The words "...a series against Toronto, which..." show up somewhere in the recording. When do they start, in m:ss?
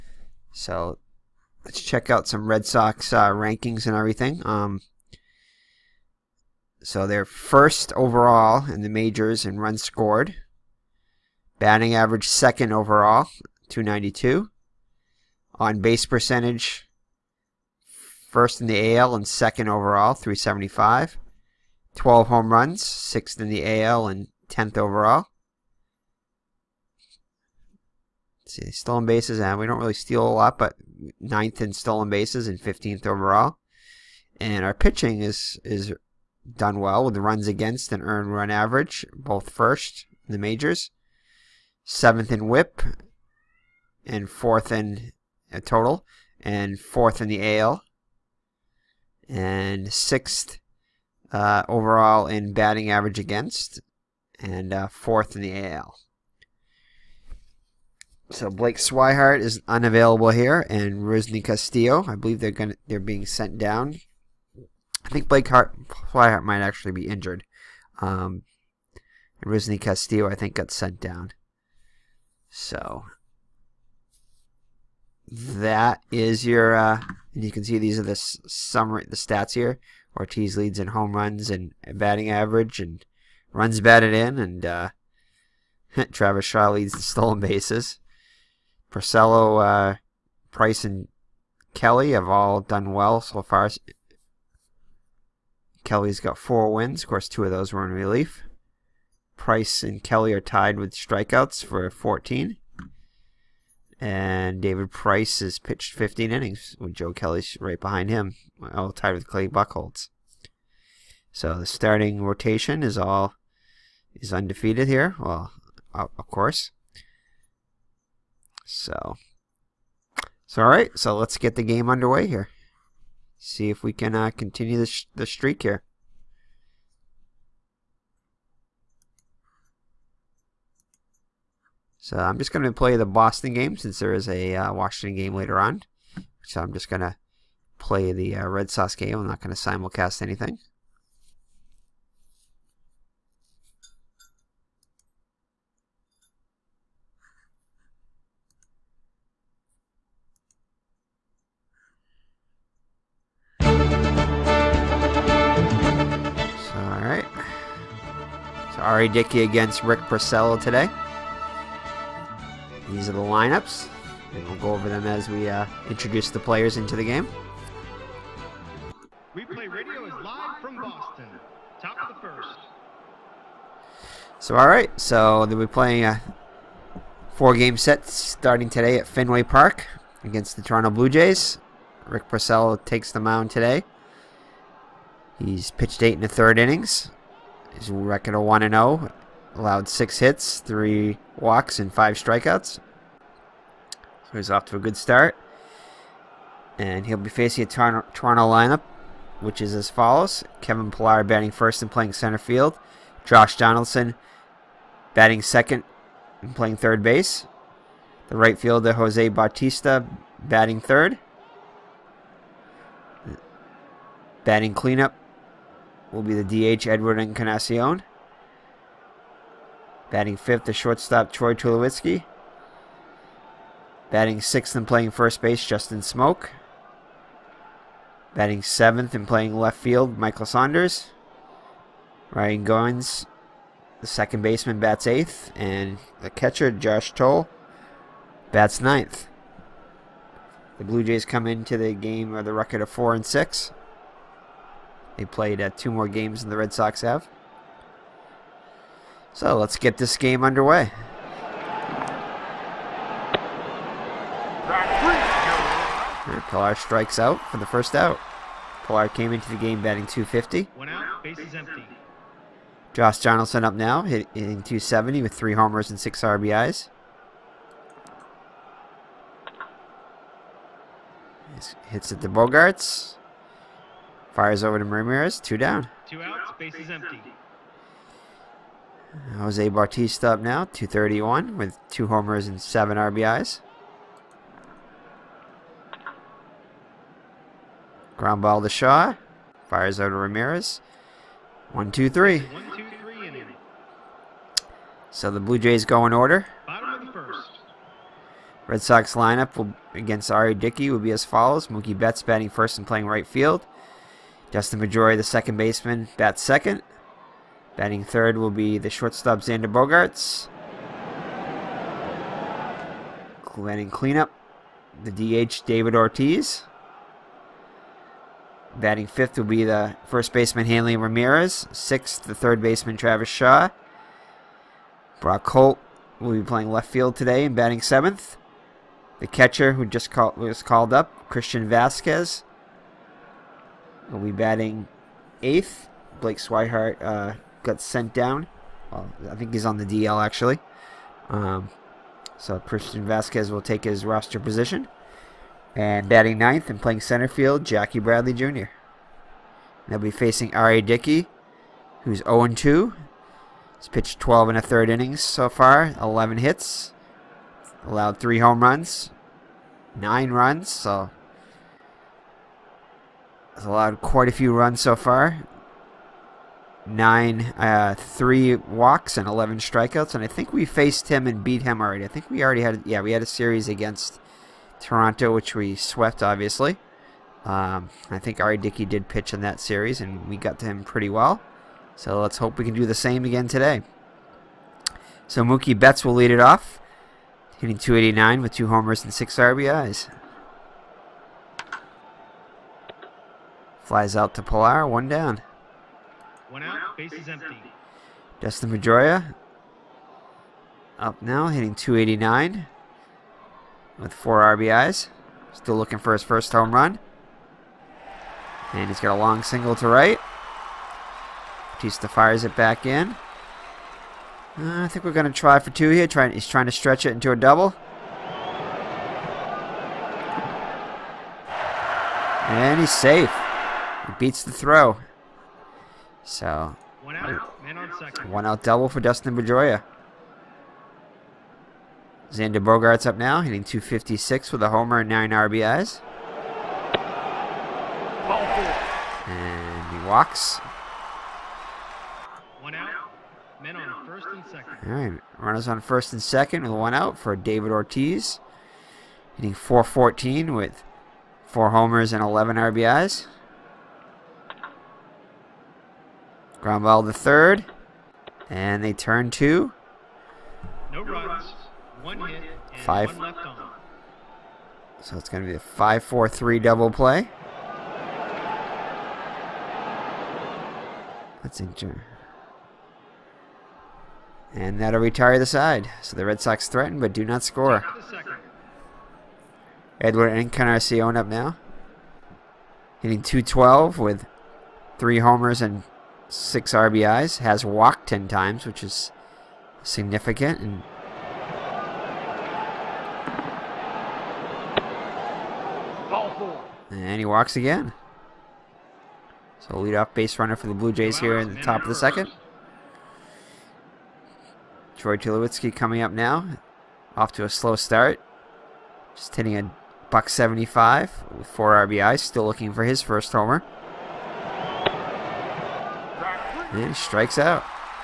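6:13.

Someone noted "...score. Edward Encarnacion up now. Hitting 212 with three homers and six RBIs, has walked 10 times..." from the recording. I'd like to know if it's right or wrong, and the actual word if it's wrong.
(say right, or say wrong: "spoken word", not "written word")
right.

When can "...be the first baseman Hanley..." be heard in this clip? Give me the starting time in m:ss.
5:19.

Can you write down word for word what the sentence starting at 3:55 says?
And the catcher, Josh Thole, bats ninth.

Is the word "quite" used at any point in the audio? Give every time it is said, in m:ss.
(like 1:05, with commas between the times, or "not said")
6:03.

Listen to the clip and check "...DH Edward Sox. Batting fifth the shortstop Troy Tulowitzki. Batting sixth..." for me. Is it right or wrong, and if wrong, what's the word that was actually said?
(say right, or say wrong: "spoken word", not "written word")
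wrong: "Encarnacion", not "Sox".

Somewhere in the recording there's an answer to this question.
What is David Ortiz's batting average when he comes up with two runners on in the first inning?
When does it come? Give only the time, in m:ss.
7:29.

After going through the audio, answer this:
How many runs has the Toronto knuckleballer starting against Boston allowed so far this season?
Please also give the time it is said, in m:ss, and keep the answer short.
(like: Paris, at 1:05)
9, at 5:59.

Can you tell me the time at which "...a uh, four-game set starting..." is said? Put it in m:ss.
2:56.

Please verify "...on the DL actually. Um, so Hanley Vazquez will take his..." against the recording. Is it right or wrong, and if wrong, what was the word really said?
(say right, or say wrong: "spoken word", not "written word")
wrong: "Christian", not "Hanley".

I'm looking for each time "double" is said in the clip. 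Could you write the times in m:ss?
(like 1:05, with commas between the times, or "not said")
6:57, 7:08, 7:46.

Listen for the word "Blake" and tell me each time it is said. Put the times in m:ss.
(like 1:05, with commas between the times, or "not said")
0:58, 1:05, 5:36.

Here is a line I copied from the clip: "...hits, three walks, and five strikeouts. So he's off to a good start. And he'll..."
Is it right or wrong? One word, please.
right.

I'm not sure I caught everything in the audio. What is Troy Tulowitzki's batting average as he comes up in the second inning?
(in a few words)
175.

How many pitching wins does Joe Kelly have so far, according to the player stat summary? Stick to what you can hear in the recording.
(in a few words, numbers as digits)
4.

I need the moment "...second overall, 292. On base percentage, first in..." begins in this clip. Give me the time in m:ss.
0:12.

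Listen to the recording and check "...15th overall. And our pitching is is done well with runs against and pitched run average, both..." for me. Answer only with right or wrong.
wrong.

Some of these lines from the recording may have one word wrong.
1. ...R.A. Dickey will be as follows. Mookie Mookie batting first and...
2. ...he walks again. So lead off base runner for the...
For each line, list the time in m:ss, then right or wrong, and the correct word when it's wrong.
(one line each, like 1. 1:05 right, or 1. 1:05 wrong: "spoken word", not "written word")
1. 5:00 wrong: "Betts", not "Mookie"
2. 8:17 right.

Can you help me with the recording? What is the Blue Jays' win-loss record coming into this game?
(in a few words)
4 and 6.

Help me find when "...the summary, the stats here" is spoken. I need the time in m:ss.
1:18.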